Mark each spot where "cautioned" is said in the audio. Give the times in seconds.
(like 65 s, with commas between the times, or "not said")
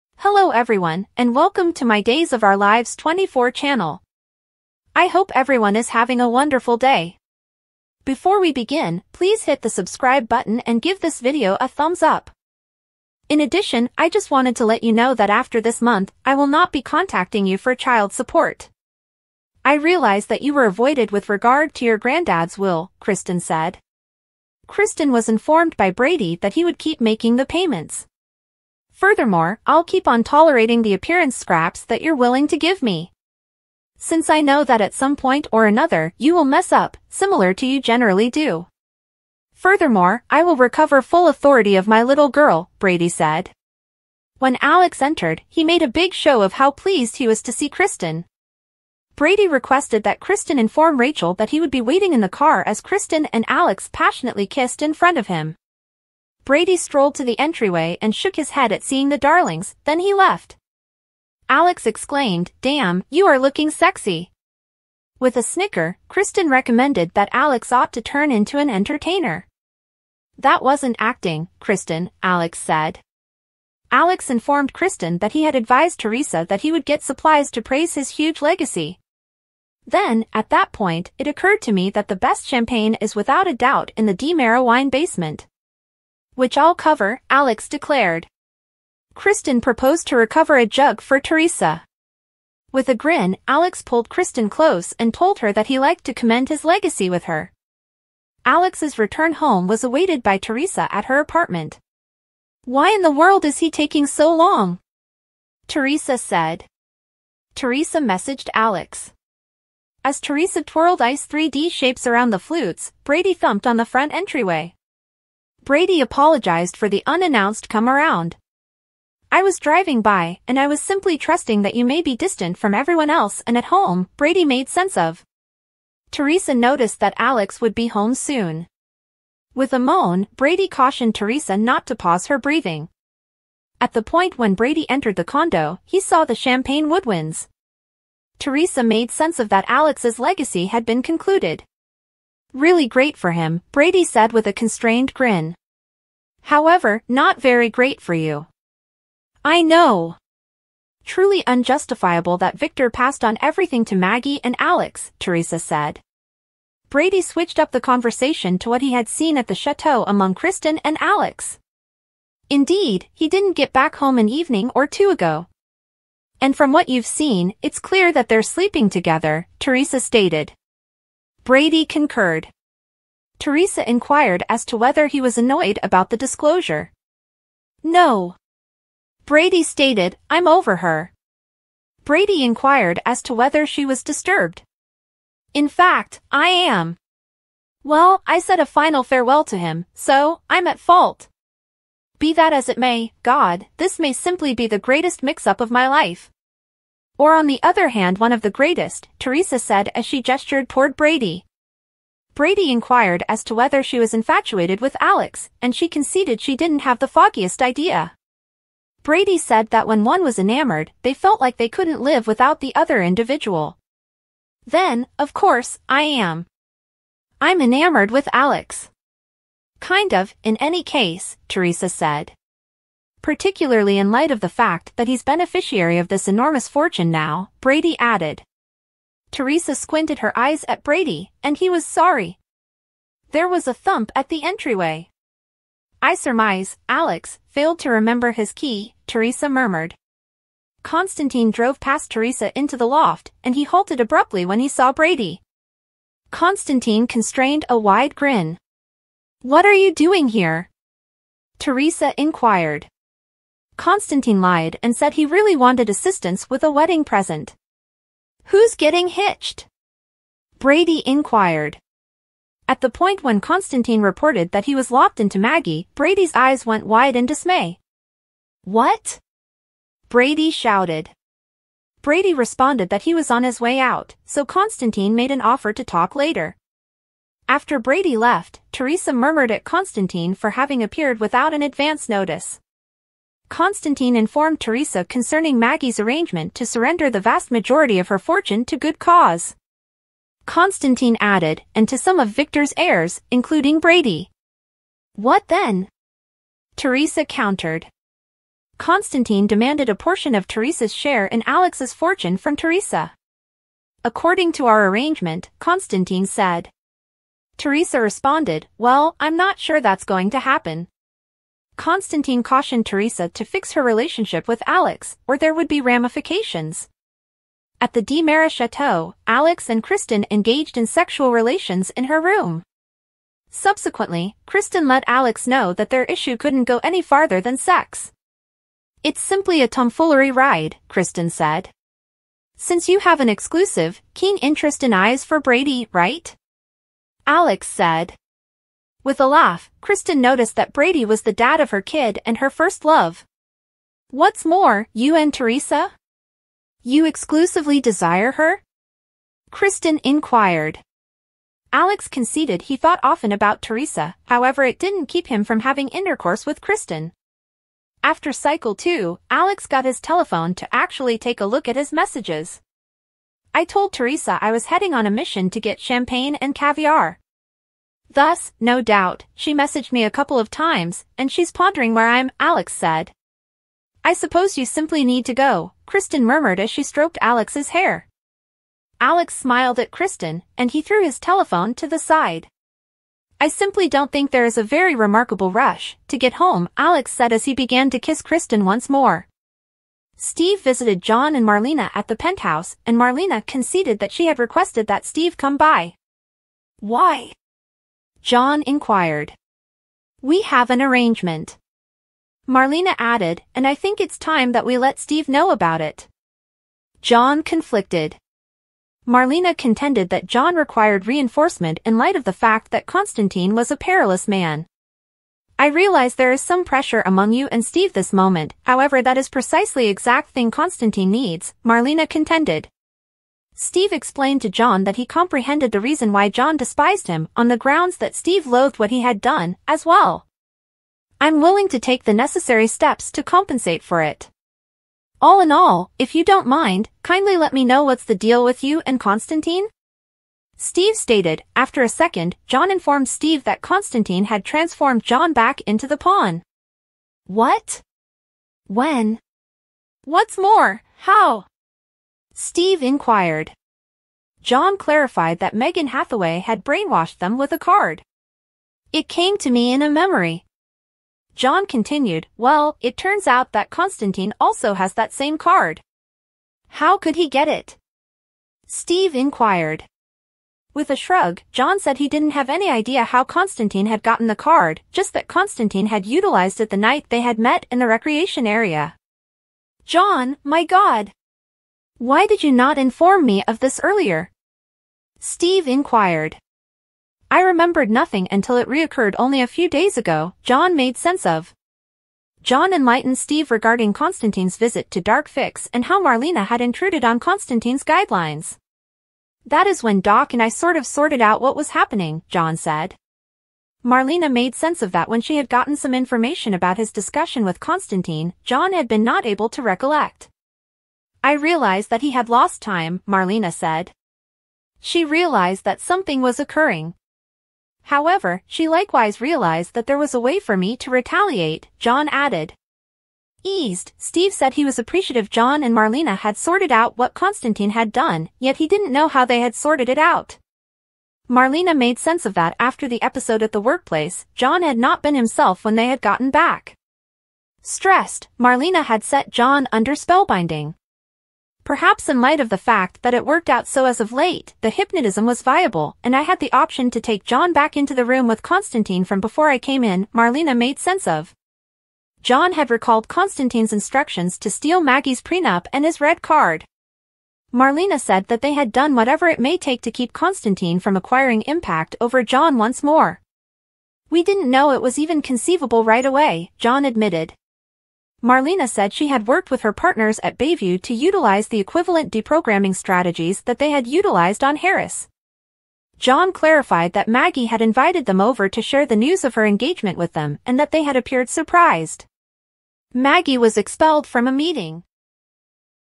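130 s, 312 s.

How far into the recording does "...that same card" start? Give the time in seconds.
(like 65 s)
464 s.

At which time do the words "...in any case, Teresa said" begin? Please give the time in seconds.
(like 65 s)
220 s.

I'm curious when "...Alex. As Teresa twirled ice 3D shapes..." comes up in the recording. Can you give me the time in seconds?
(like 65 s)
108 s.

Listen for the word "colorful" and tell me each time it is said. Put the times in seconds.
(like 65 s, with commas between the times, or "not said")
not said.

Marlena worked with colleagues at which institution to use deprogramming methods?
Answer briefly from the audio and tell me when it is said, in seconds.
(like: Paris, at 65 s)
Bayview, at 570 s.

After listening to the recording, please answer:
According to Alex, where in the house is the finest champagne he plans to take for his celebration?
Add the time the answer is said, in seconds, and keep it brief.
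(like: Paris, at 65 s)
DiMera wine basement, at 84 s.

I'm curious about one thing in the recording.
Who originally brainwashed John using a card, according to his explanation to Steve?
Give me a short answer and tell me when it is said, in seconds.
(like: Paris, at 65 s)
Megan Hathaway, at 455 s.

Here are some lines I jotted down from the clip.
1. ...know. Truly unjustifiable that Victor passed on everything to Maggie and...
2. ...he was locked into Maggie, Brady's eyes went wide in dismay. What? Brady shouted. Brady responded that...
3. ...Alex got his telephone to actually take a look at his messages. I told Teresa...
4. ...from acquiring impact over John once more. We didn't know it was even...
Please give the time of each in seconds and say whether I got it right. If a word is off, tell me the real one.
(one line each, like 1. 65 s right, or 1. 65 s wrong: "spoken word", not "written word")
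1. 149 s right
2. 264 s right
3. 359 s right
4. 560 s right.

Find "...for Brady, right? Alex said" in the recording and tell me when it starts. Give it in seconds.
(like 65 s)
335 s.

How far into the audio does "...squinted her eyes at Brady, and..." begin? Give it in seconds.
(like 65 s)
229 s.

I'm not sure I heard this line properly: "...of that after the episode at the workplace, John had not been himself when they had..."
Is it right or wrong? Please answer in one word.
right.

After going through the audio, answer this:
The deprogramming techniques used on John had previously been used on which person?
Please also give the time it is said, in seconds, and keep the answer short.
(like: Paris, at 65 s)
Harris, at 574 s.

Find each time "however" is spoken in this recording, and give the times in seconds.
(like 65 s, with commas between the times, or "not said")
146 s, 354 s, 418 s, 517 s.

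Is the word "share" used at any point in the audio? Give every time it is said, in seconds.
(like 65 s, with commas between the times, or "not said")
300 s, 578 s.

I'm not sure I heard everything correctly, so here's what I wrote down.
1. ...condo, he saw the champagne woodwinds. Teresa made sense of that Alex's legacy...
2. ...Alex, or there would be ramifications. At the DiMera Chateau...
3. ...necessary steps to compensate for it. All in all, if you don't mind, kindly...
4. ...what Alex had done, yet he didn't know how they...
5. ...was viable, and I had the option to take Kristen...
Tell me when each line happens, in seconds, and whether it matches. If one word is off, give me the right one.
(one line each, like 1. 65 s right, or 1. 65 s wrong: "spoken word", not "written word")
1. 135 s right
2. 314 s right
3. 432 s right
4. 526 s wrong: "Constantine", not "Alex"
5. 545 s wrong: "John", not "Kristen".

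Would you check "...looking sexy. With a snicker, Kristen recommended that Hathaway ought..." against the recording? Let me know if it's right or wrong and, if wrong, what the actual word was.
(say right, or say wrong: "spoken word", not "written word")
wrong: "Alex", not "Hathaway".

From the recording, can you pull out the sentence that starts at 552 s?
John had recalled Constantine's instructions to steal Maggie's prenup and his red card.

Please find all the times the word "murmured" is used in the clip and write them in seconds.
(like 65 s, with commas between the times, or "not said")
239 s, 279 s, 376 s.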